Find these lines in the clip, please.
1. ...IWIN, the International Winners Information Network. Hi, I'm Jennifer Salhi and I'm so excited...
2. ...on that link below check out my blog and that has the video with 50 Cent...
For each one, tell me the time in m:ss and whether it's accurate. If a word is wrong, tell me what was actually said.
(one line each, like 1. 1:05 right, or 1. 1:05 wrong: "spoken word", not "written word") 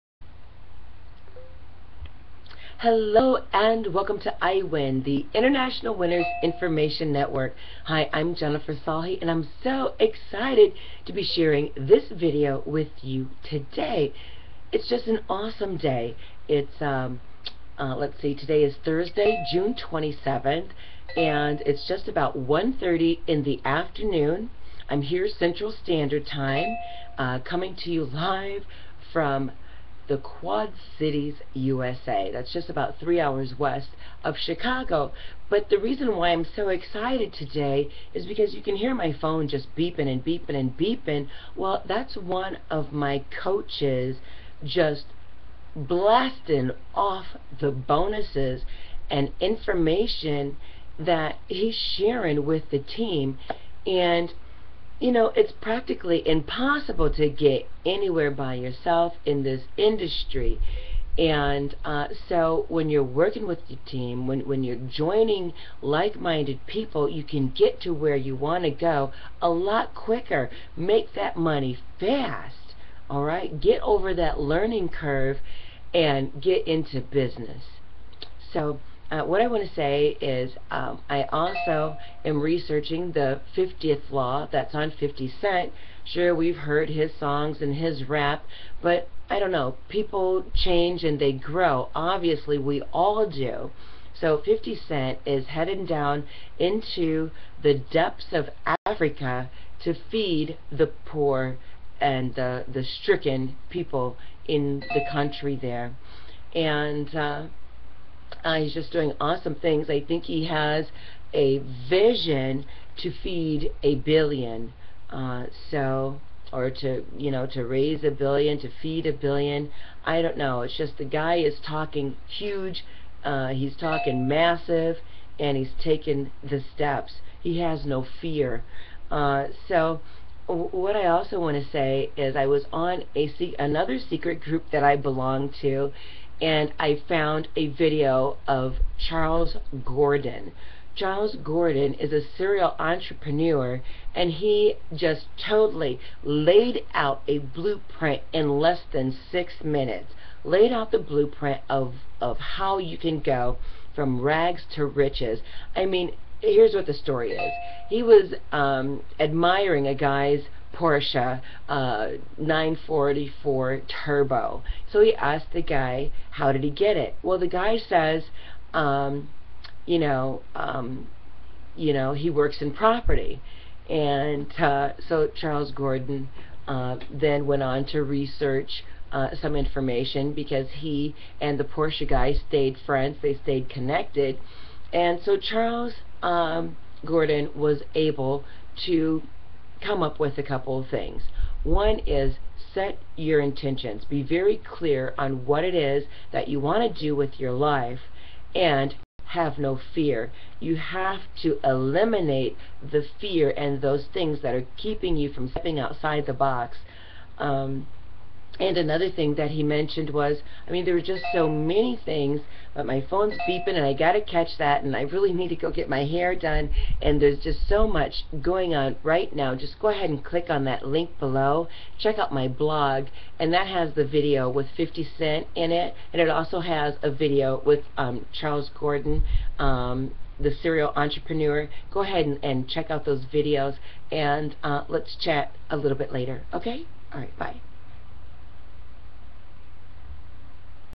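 1. 0:04 right
2. 3:40 right.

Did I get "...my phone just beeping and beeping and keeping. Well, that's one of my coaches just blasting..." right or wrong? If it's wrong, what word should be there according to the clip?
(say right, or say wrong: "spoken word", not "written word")
wrong: "beeping", not "keeping".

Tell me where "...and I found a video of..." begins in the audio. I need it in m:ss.
2:16.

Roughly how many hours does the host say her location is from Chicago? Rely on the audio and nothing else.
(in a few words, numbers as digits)
3 hours.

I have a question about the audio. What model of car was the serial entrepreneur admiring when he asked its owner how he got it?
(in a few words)
Porsche 944 Turbo.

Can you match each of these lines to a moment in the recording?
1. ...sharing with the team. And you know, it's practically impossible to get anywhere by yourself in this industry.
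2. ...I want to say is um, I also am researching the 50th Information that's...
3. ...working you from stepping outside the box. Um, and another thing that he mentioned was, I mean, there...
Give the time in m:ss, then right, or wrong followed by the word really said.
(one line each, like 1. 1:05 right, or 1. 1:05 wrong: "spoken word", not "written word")
1. 0:51 right
2. 1:19 wrong: "Law", not "Information"
3. 3:24 wrong: "keeping", not "working".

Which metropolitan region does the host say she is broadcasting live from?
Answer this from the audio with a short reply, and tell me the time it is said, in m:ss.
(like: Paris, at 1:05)
Quad Cities, at 0:30.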